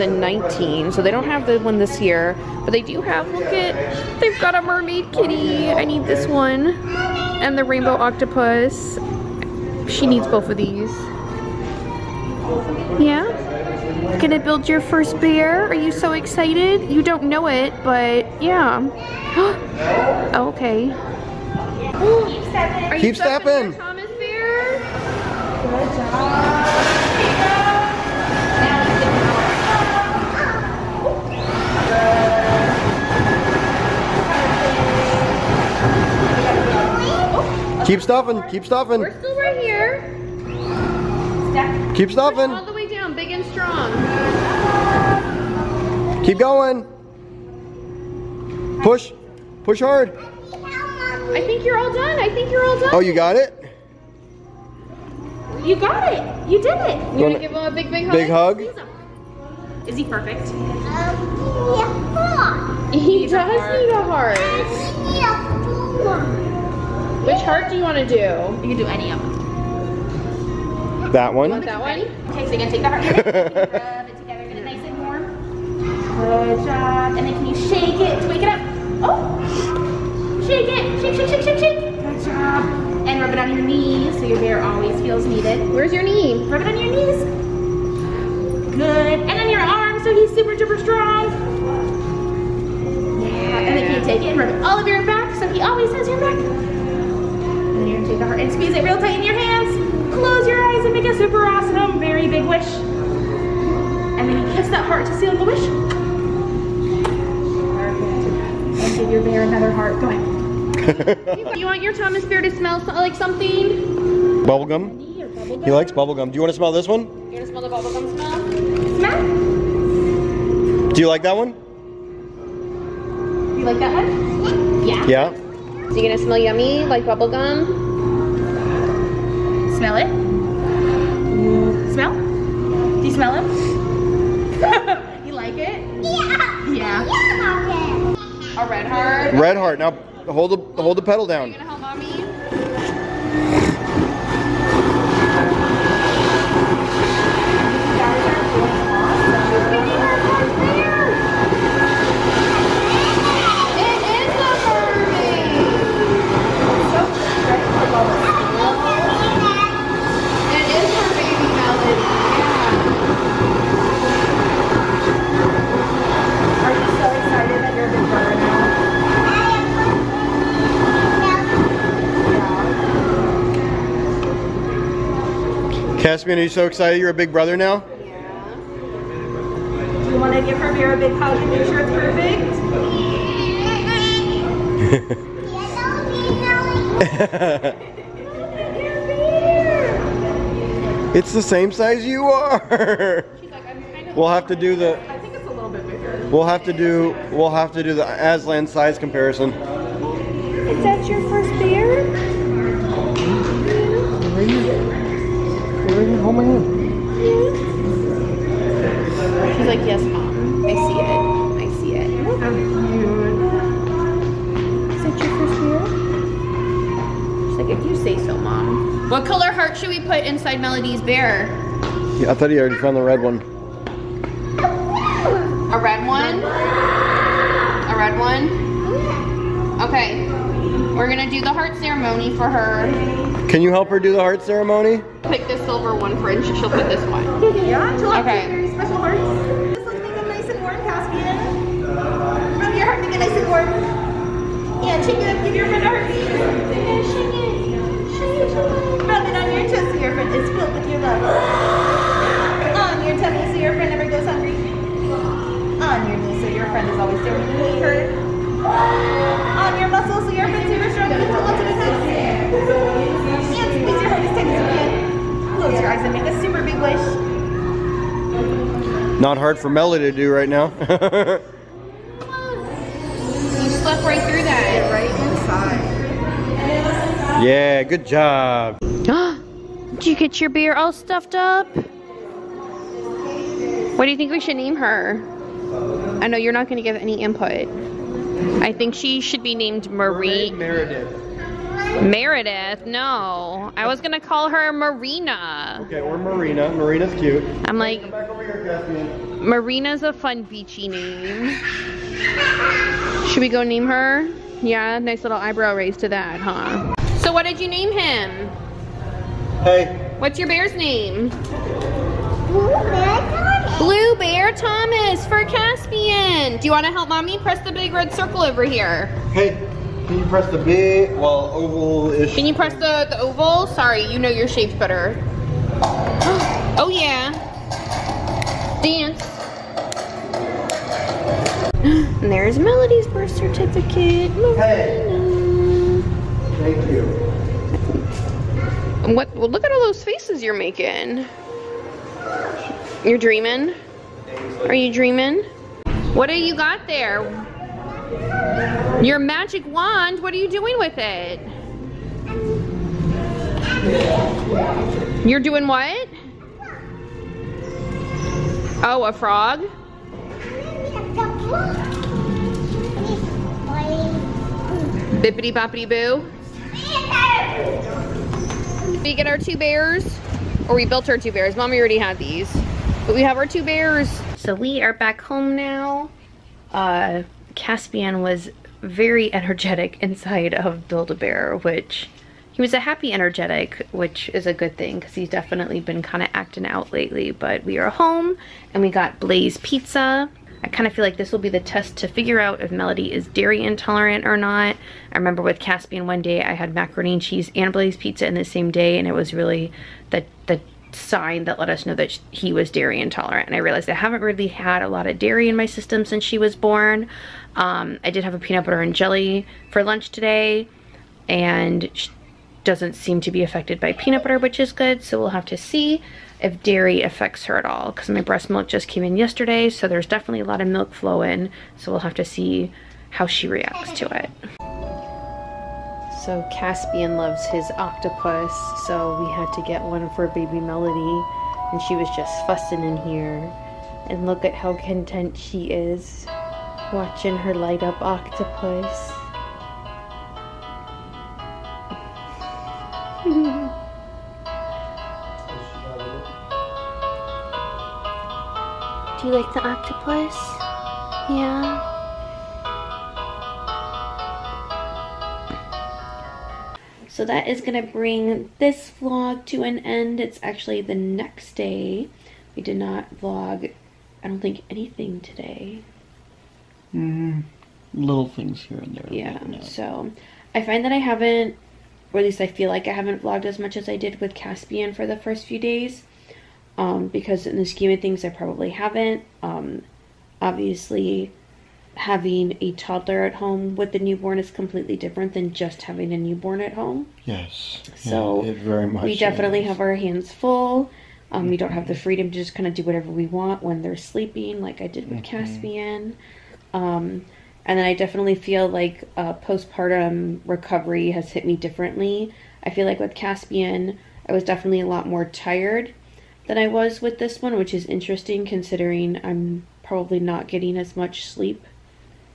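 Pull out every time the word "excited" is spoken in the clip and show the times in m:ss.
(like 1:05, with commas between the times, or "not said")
0:16, 2:56.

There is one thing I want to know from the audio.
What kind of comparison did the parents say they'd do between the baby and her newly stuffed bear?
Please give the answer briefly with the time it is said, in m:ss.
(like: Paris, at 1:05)
Aslan size comparison, at 3:18.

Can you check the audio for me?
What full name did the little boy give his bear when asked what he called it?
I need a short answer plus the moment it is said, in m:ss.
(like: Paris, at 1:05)
Blue Bear Thomas, at 5:13.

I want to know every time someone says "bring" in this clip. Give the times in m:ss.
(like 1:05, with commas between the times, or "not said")
7:37.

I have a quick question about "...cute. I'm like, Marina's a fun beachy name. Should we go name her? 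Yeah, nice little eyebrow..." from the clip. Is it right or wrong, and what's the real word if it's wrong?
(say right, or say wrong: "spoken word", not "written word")
right.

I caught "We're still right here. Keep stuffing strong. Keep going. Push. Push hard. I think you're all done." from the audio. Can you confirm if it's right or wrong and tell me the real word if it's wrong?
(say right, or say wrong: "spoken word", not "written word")
right.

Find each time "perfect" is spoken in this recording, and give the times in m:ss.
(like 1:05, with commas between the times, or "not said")
1:00, 3:01.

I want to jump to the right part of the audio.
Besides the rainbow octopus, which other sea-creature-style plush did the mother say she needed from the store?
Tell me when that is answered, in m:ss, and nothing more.
0:04.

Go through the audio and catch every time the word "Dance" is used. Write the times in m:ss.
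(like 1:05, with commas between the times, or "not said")
5:28.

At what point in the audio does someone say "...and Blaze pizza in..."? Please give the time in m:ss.
6:37.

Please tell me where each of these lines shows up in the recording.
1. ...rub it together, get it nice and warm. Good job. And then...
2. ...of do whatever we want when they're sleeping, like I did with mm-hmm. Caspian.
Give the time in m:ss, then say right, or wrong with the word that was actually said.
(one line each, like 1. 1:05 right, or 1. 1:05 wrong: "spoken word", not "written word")
1. 1:13 right
2. 8:12 right.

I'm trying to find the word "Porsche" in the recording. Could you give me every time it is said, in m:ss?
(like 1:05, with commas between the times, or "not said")
not said.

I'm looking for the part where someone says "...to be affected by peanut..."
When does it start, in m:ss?
6:53.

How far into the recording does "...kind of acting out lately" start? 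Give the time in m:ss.
6:26.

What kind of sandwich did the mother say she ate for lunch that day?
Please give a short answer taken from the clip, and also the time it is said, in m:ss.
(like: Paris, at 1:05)
peanut butter and jelly, at 6:48.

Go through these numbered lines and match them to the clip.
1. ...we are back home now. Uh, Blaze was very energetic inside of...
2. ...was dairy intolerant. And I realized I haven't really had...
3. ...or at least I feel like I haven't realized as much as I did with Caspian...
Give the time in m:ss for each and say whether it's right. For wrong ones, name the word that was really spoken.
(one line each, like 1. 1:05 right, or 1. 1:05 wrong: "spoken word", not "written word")
1. 6:14 wrong: "Caspian", not "Blaze"
2. 6:42 right
3. 7:52 wrong: "vlogged", not "realized".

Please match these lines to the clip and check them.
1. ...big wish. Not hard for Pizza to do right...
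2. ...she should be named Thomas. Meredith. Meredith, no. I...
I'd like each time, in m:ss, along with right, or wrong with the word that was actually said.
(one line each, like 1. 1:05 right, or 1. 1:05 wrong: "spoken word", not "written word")
1. 4:26 wrong: "Melly", not "Pizza"
2. 4:48 wrong: "Marie", not "Thomas".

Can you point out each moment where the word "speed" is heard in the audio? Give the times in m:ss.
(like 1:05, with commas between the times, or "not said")
not said.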